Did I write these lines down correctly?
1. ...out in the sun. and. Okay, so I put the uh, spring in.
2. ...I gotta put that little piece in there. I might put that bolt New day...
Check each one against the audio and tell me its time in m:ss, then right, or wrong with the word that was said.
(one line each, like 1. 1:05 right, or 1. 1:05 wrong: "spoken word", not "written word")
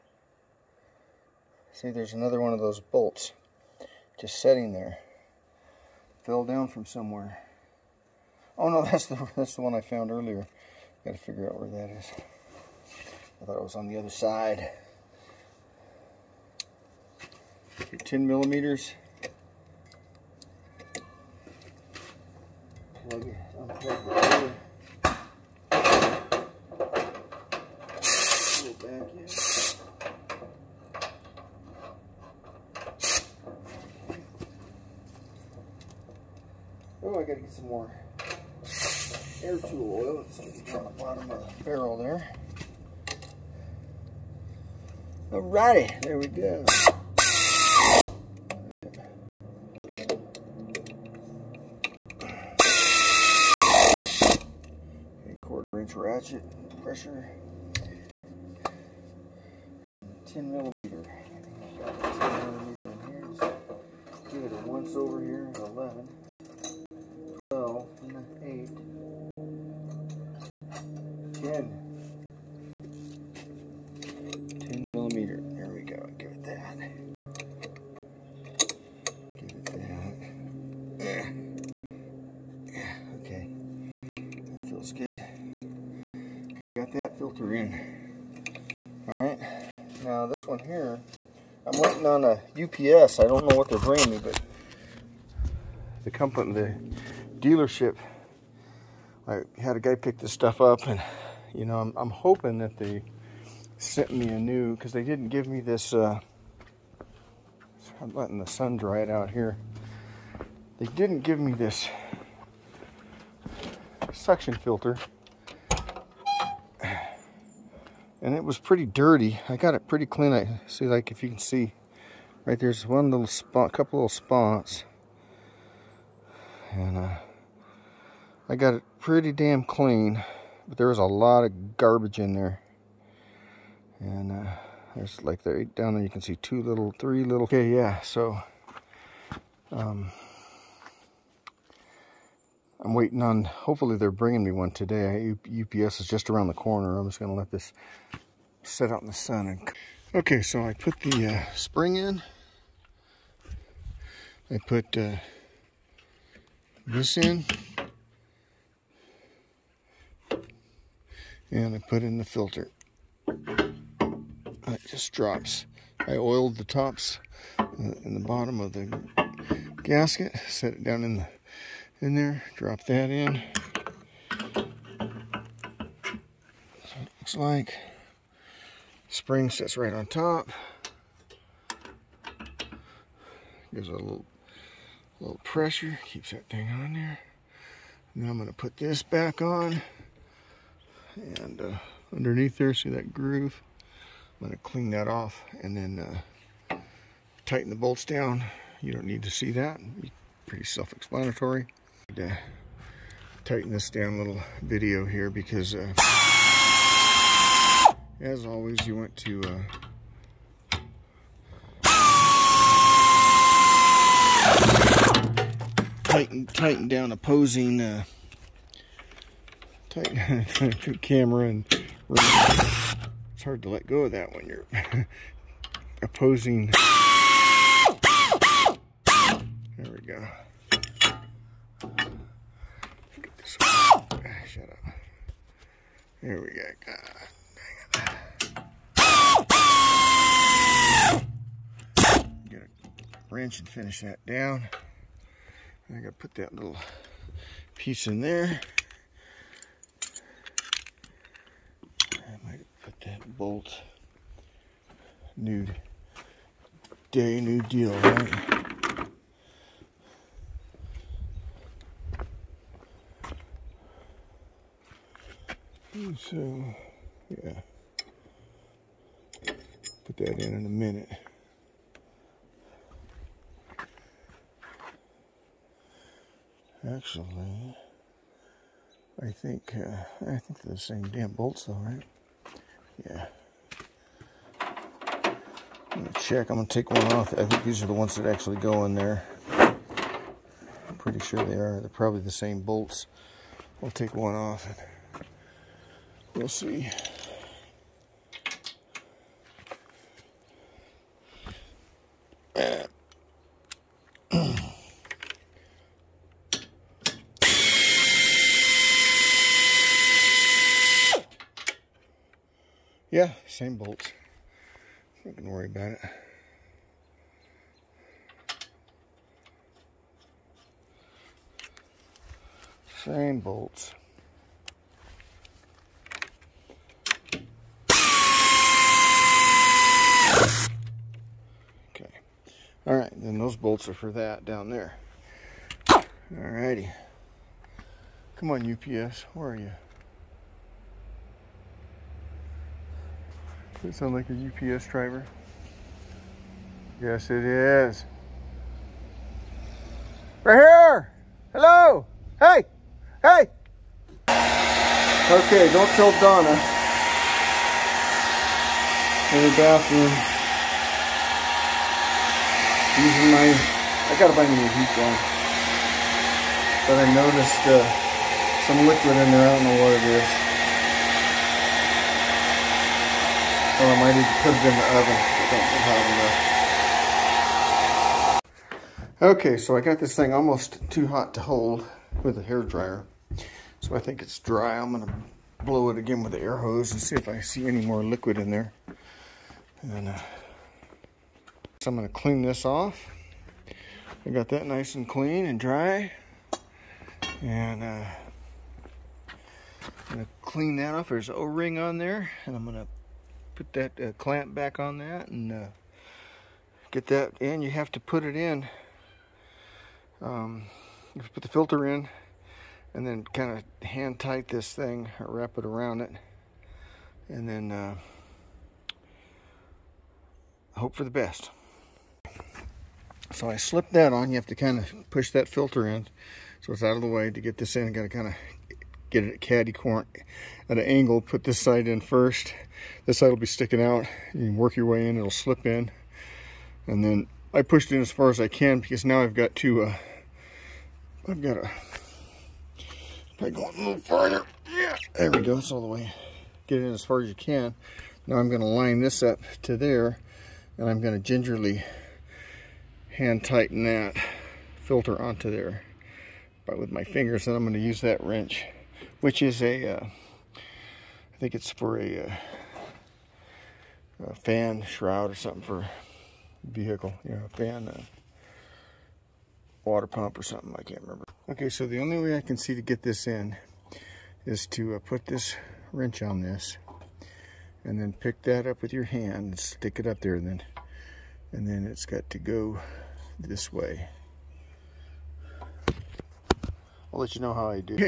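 1. 2:28 right
2. 4:05 right.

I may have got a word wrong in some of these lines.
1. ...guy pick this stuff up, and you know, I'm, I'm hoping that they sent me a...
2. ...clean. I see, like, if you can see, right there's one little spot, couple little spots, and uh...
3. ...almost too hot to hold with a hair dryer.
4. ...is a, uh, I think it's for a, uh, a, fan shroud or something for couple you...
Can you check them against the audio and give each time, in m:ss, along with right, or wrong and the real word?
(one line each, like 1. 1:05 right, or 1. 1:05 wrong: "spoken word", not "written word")
1. 1:39 right
2. 2:00 right
3. 6:20 right
4. 7:39 wrong: "vehicle", not "couple".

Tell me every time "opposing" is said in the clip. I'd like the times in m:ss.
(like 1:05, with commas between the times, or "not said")
3:37, 3:46.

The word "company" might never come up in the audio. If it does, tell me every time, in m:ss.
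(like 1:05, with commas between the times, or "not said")
1:36.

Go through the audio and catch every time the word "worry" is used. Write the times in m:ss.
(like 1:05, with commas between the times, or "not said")
5:15.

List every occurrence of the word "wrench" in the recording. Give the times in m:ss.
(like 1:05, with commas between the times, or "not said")
4:03, 7:38, 7:55.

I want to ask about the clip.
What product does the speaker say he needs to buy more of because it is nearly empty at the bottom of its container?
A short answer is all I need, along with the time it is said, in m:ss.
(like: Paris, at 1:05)
air tool oil, at 0:39.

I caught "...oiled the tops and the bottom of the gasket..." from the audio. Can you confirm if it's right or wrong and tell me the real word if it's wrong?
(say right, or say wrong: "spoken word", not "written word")
right.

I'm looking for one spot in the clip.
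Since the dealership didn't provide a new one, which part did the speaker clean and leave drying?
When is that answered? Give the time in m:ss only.
1:54.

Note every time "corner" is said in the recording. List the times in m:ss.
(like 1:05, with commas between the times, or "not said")
2:26, 7:09.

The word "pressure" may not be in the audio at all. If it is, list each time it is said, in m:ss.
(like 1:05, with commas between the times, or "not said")
0:56, 3:05.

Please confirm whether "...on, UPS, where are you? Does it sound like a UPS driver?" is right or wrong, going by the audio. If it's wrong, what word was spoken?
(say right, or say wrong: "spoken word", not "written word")
right.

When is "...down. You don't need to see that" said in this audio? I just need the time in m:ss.
3:18.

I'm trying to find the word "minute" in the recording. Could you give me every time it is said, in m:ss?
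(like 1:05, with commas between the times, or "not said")
4:30.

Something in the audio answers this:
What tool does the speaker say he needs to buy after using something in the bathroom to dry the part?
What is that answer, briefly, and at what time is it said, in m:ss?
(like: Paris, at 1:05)
heat gun, at 6:04.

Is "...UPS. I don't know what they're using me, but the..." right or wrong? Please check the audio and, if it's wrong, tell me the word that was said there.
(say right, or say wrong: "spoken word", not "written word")
wrong: "bringing", not "using".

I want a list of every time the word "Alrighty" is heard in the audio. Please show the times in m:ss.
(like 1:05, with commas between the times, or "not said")
0:45.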